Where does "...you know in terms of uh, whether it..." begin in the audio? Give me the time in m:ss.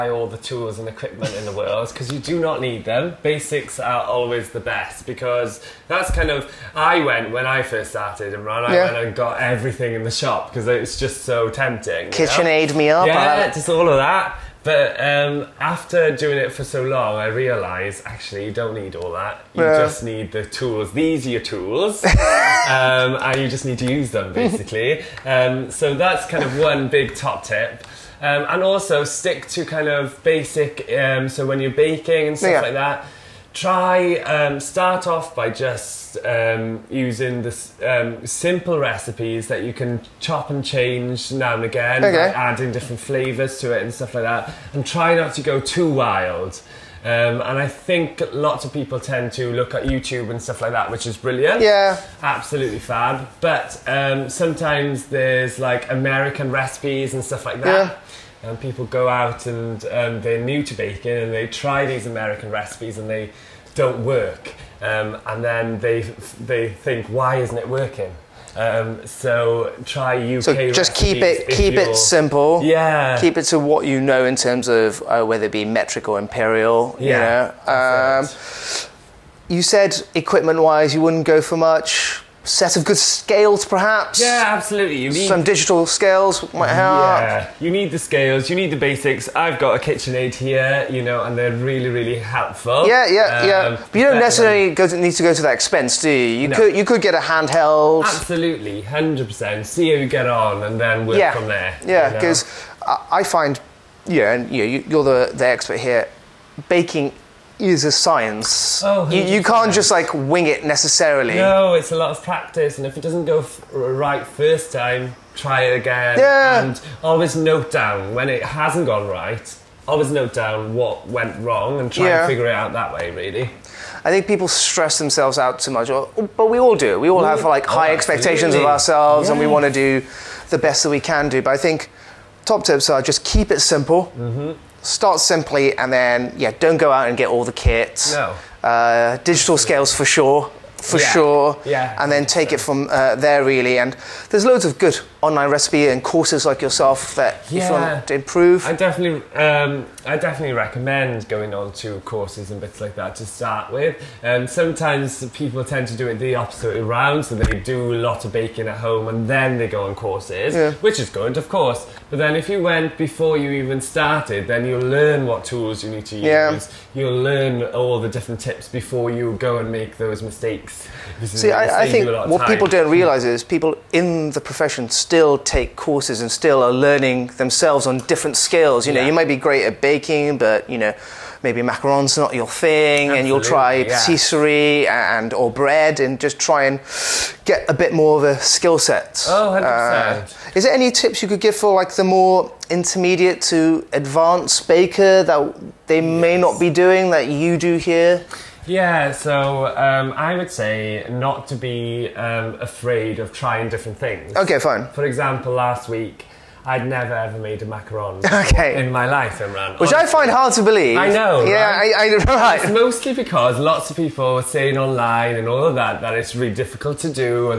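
1:13.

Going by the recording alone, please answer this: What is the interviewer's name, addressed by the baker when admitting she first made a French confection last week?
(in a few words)
Imran.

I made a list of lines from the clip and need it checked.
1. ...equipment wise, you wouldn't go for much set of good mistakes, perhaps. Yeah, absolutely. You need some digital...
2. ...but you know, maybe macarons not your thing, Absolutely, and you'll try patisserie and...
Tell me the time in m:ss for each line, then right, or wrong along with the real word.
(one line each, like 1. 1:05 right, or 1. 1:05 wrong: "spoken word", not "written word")
1. 1:20 wrong: "scales", not "mistakes"
2. 3:00 right.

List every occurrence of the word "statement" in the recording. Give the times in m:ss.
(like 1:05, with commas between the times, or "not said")
not said.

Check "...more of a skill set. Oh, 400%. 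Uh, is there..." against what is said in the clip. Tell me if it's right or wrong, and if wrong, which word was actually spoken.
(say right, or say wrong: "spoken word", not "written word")
wrong: "100", not "400".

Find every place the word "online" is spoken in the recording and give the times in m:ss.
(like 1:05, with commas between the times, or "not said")
2:25, 3:34.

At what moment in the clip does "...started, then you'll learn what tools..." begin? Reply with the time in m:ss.
2:43.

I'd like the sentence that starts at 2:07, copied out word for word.
We all have like high oh, expectations of ourselves, and we want to do the best that we can do.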